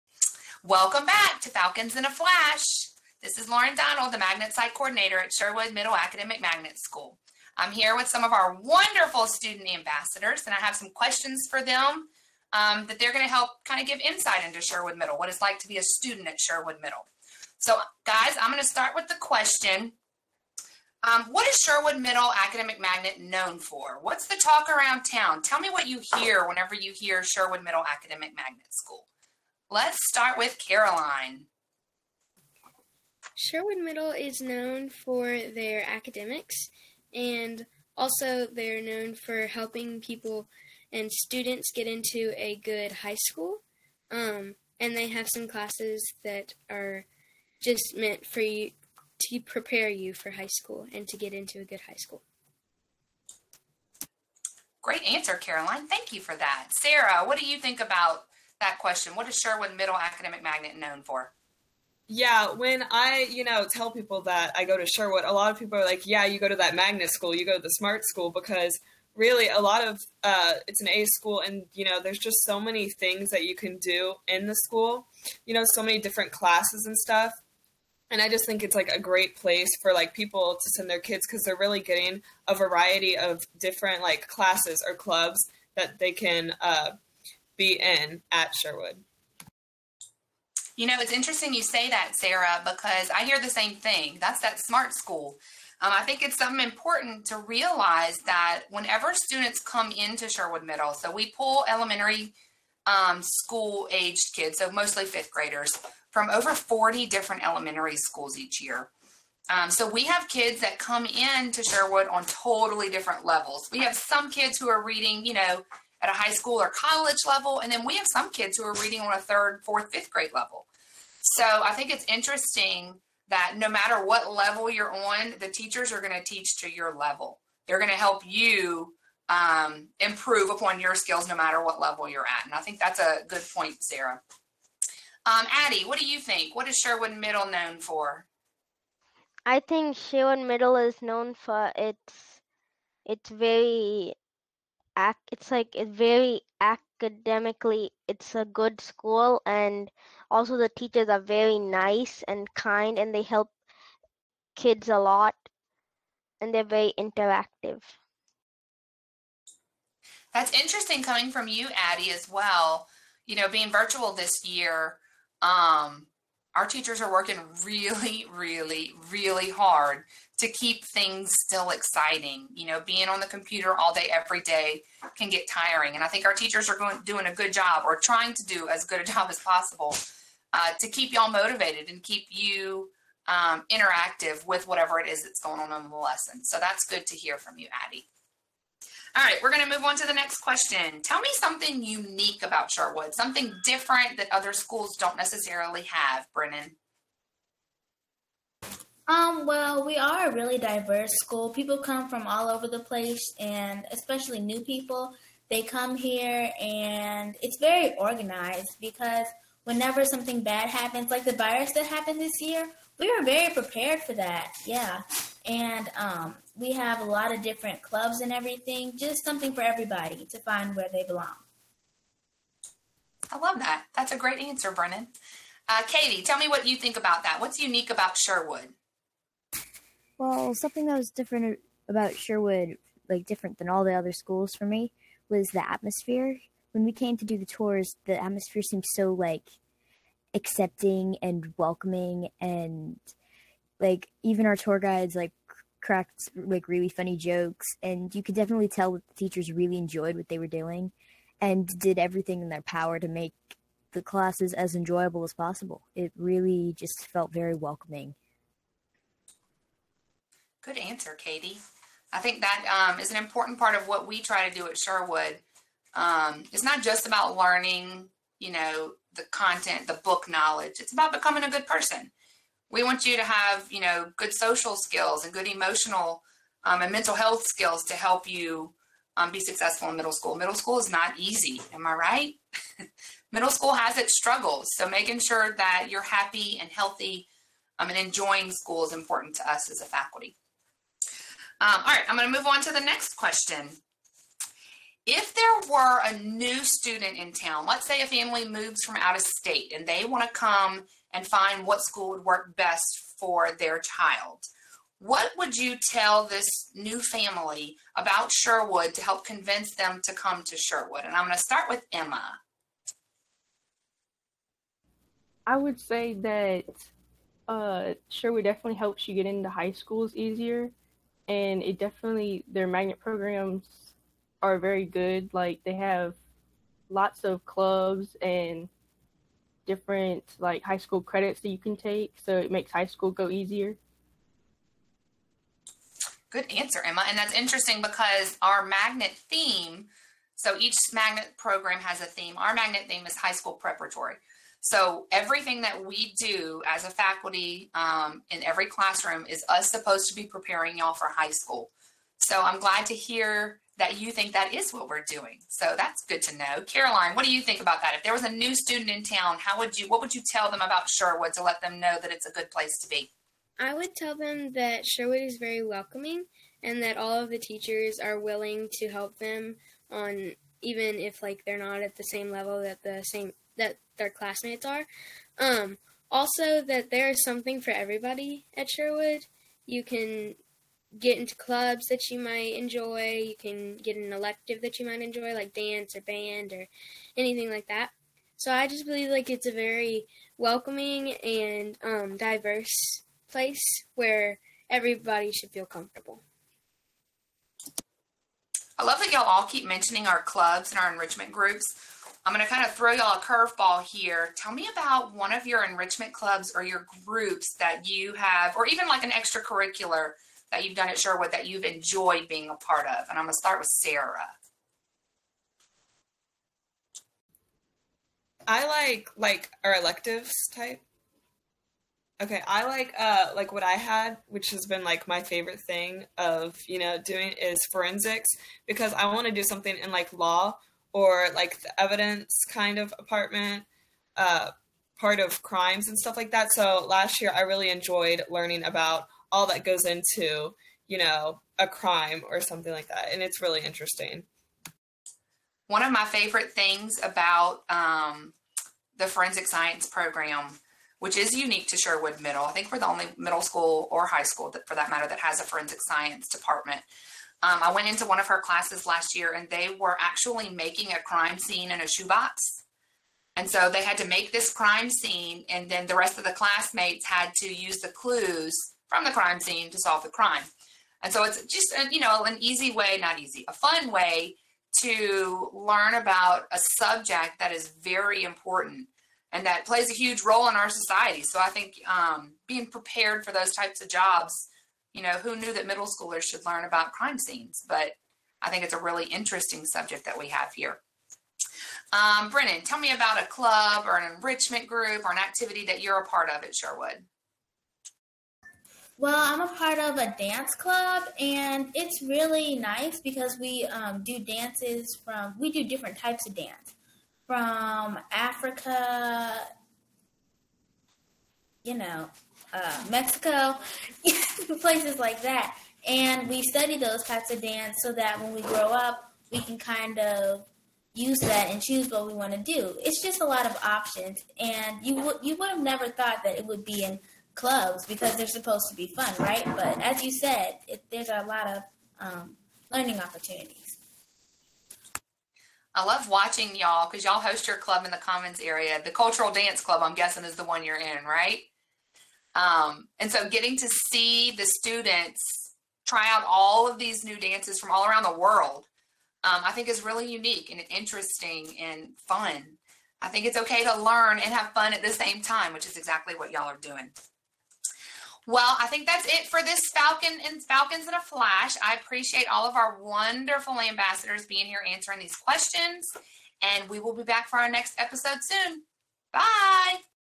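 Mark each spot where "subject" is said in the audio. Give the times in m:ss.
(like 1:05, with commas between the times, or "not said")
7:56, 8:09.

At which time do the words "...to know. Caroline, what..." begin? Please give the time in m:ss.
5:56.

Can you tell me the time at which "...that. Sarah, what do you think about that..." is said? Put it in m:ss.
0:56.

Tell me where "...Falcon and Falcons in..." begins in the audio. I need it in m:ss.
9:19.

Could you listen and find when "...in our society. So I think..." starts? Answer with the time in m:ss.
8:00.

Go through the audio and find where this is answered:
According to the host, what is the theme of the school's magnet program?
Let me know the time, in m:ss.
5:43.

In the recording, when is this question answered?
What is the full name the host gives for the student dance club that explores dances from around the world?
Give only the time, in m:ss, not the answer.
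8:58.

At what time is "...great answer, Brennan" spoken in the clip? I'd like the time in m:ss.
3:44.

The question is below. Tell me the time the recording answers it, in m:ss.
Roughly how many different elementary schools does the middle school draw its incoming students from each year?
1:46.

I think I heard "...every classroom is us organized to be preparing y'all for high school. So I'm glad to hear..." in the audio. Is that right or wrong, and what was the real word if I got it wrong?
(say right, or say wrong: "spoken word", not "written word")
wrong: "supposed", not "organized".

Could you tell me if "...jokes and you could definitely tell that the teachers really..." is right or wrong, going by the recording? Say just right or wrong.
right.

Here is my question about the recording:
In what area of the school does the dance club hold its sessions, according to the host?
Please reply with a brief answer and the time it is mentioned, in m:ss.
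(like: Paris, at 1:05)
the Commons area, at 8:57.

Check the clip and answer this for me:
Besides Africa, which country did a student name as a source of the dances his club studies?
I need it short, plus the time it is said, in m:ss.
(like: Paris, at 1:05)
Mexico, at 8:32.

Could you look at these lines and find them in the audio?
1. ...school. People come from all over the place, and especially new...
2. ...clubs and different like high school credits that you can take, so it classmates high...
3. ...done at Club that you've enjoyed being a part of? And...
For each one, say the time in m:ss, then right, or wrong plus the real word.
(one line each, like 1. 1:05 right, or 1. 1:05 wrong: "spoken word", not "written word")
1. 3:21 right
2. 5:27 wrong: "makes", not "classmates"
3. 6:50 wrong: "Sherwood", not "Club".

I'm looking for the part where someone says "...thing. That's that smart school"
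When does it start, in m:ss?
1:33.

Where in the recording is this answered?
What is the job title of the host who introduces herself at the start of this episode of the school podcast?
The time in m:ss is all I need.
0:04.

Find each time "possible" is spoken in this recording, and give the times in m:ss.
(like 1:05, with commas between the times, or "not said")
2:59, 4:15.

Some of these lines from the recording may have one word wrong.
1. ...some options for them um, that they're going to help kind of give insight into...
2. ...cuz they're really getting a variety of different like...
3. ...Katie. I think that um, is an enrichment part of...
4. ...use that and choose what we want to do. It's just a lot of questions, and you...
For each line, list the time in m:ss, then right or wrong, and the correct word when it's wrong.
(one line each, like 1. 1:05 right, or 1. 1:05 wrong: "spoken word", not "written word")
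1. 0:10 wrong: "questions", not "options"
2. 1:21 right
3. 4:21 wrong: "important", not "enrichment"
4. 8:40 wrong: "options", not "questions".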